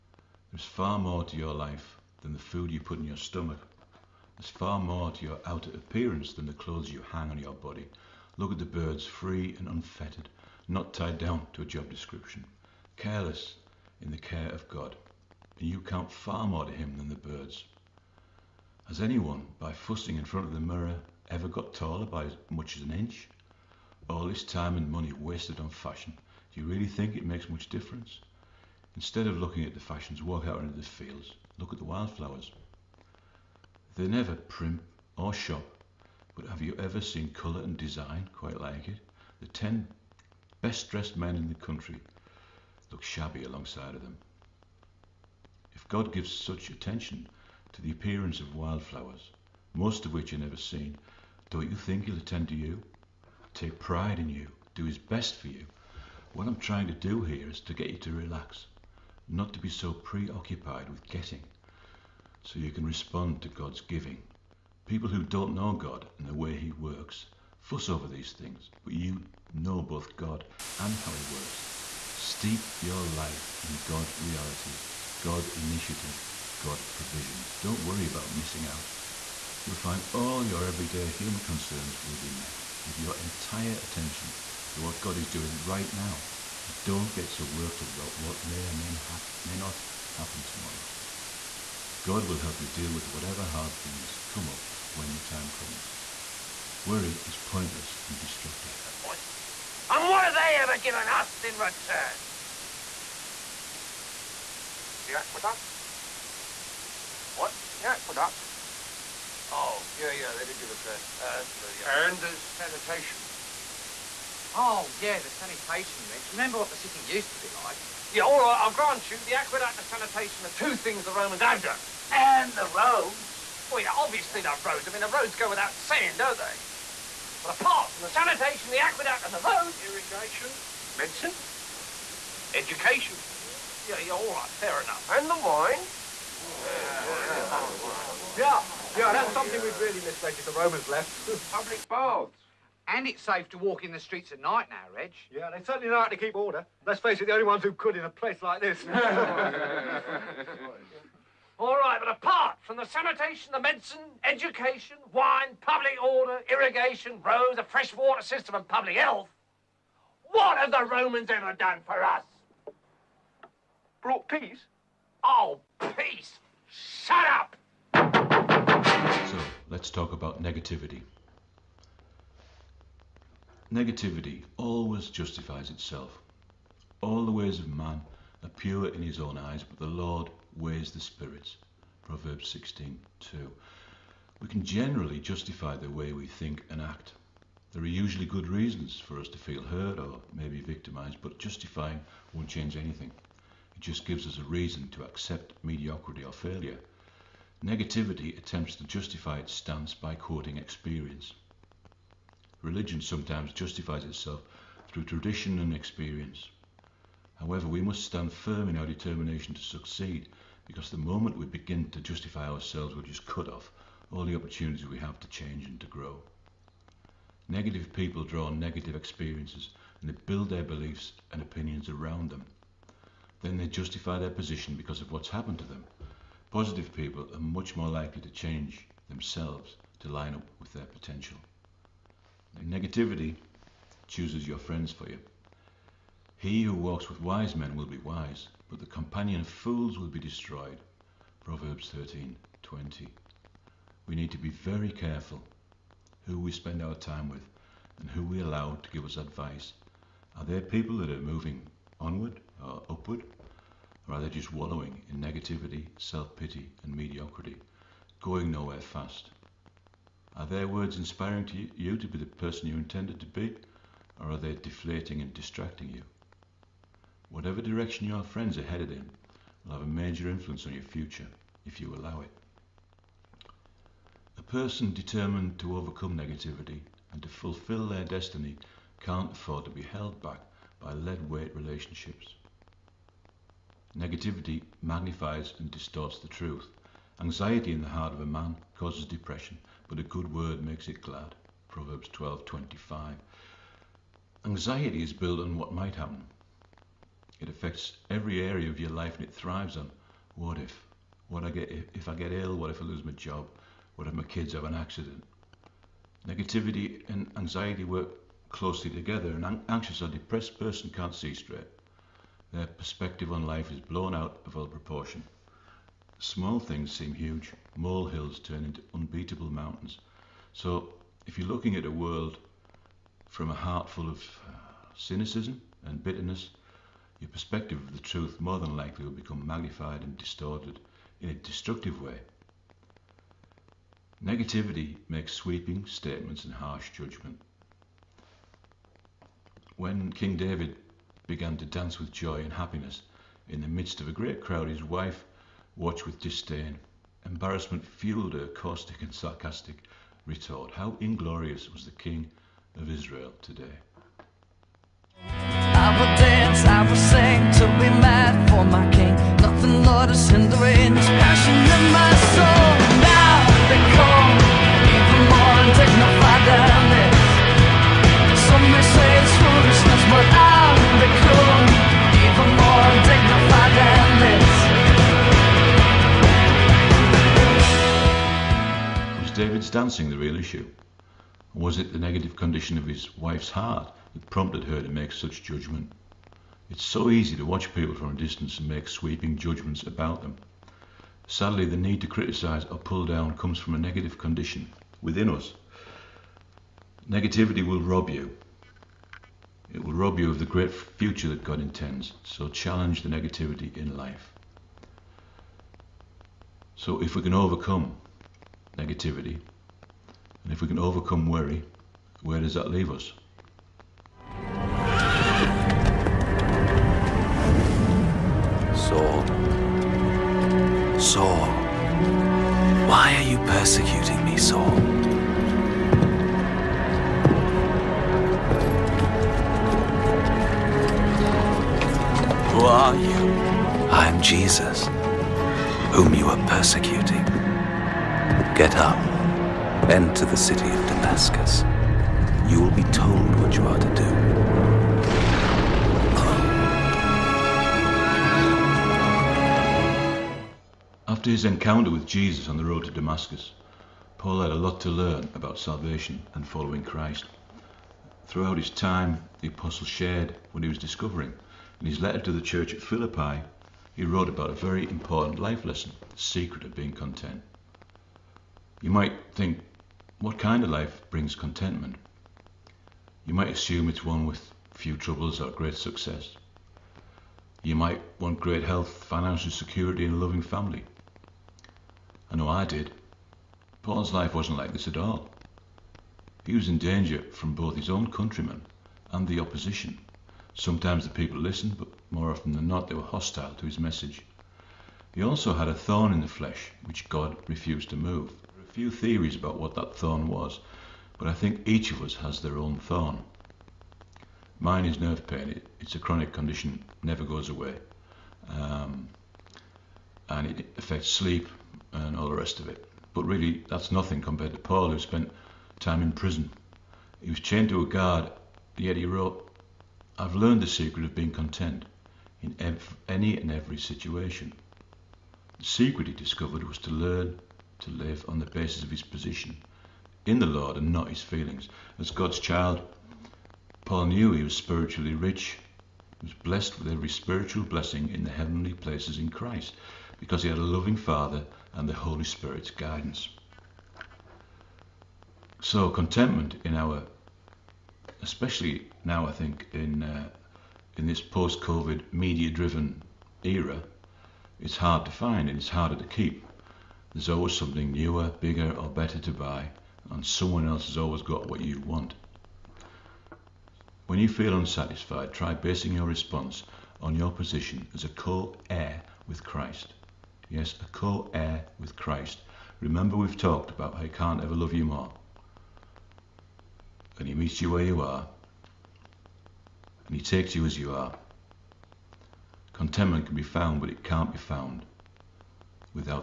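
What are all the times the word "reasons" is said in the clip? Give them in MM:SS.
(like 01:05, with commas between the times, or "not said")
03:08, 03:14.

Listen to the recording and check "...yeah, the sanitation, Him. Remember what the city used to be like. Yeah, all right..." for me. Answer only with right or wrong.
wrong.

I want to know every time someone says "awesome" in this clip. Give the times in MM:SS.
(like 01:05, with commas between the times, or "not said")
not said.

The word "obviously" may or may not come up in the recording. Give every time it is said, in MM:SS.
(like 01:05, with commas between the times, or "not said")
02:03.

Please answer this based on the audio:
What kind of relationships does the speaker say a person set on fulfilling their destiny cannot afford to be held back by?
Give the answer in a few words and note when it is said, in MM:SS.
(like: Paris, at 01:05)
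lead weight relationships, at 04:40.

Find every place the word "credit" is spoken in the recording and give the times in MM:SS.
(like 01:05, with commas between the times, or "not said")
not said.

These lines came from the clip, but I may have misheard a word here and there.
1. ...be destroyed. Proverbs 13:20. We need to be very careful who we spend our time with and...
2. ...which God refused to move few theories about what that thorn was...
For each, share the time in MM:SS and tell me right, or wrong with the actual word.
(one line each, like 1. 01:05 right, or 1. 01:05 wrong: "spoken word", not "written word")
1. 04:00 right
2. 08:16 right.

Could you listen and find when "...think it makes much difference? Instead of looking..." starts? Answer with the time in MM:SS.
00:26.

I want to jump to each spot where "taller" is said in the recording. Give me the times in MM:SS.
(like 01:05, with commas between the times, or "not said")
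00:21.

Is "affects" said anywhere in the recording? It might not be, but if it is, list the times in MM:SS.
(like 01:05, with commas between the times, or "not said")
04:57, 08:30.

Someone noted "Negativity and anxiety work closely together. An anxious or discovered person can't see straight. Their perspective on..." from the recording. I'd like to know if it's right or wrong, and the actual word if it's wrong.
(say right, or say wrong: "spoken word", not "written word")
wrong: "depressed", not "discovered".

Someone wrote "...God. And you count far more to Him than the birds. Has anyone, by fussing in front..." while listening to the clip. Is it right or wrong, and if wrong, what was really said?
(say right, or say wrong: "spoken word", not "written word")
right.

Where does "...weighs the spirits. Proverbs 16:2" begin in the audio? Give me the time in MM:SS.
03:00.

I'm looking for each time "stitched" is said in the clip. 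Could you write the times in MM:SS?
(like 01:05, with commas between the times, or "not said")
not said.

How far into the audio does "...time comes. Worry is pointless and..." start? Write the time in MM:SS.
01:35.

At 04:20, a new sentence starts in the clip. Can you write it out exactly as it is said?
Are their words inspiring to you to be the person you intended to be, or are they deflating and distracting you?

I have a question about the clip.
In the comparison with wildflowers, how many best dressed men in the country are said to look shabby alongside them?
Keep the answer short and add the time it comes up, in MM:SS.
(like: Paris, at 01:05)
10, at 00:39.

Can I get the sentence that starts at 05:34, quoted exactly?
Negativity makes sweeping statements and harsh judgment.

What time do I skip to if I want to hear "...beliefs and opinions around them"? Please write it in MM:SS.
03:40.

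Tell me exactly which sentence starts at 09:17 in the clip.
There's always something newer, bigger, or better to buy, and someone else has always got what you want.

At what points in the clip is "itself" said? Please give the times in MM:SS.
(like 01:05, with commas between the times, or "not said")
02:55, 03:24.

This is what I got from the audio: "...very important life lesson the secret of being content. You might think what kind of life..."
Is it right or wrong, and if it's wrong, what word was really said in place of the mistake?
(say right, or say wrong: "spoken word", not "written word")
right.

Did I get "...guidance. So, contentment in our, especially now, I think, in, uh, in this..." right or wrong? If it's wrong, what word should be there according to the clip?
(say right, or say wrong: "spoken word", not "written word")
right.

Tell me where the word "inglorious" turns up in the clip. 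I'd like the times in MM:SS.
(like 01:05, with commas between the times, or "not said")
05:51.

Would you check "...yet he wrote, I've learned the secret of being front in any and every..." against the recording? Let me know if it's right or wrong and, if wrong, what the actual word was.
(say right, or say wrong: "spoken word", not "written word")
wrong: "content", not "front".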